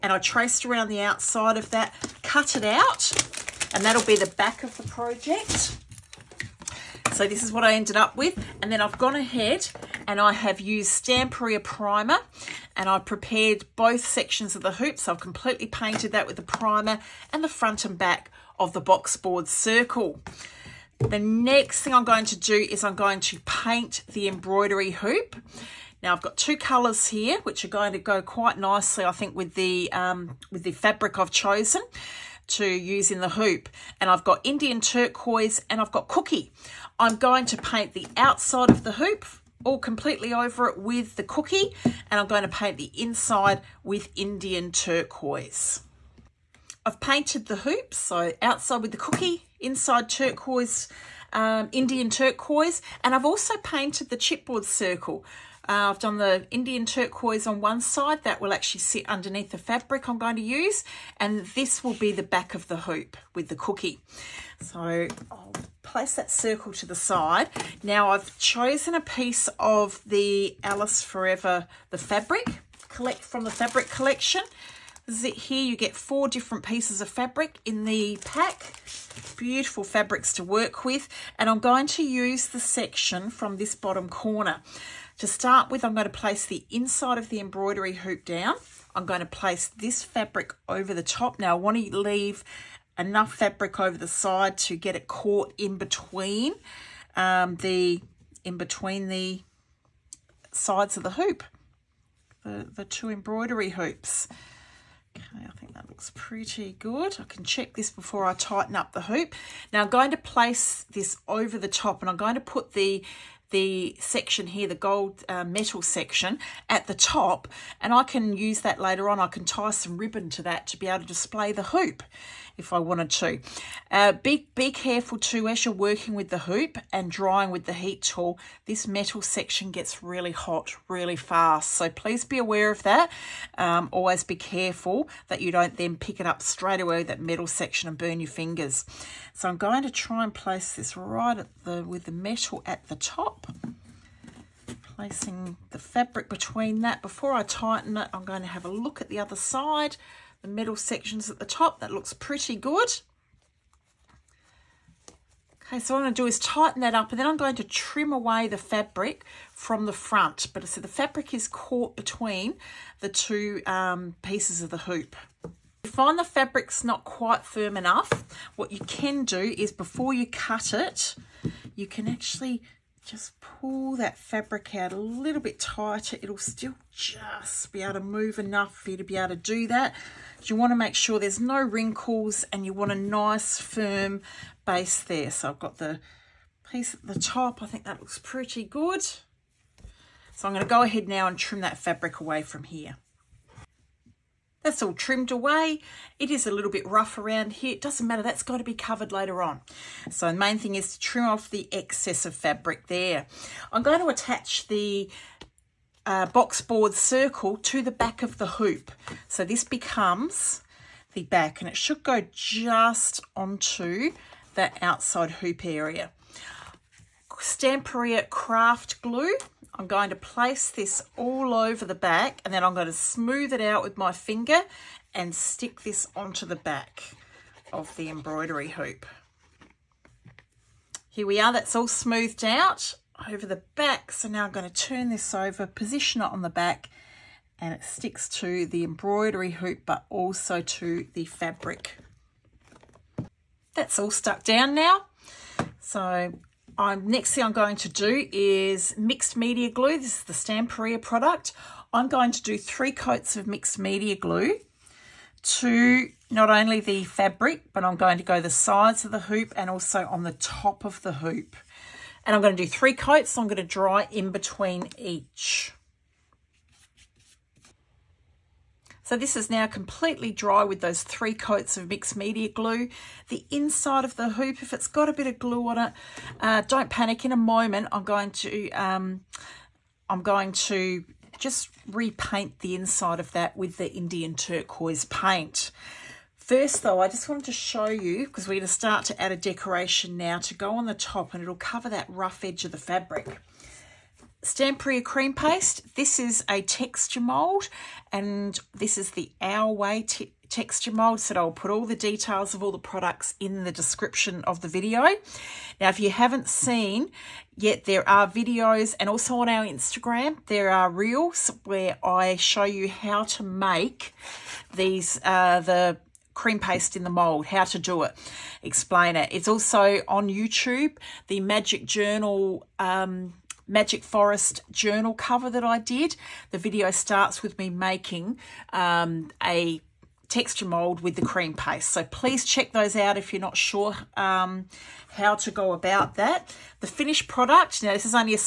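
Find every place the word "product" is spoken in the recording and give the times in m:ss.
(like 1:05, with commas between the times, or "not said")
4:11, 5:02, 5:37.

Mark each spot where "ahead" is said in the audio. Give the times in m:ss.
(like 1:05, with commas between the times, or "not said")
0:09, 3:10.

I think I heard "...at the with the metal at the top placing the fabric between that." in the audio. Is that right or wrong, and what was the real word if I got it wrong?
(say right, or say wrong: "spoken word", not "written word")
right.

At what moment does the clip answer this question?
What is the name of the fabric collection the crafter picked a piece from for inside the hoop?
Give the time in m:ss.
1:10.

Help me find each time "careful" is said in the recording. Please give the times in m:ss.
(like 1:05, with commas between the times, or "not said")
2:04, 2:14.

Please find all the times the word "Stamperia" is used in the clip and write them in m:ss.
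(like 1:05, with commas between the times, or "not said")
0:10, 3:37, 4:10, 4:54.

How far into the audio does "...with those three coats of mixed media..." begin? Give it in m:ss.
4:30.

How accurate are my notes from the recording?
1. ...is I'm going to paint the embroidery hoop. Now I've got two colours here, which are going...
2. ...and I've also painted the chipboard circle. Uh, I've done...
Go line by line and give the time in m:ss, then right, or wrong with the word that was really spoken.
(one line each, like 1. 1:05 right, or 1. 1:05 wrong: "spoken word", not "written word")
1. 0:22 right
2. 0:53 right.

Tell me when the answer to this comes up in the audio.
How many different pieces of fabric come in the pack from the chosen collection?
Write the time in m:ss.
1:15.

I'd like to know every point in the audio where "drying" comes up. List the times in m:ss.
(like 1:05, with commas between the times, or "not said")
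2:07.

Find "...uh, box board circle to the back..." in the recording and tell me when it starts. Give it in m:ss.
3:26.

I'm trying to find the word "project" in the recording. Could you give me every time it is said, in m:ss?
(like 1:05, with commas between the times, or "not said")
0:04.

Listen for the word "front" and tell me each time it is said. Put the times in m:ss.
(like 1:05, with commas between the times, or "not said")
0:17, 2:39.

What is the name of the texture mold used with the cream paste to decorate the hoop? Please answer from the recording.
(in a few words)
Our Way.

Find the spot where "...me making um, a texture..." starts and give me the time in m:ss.
5:27.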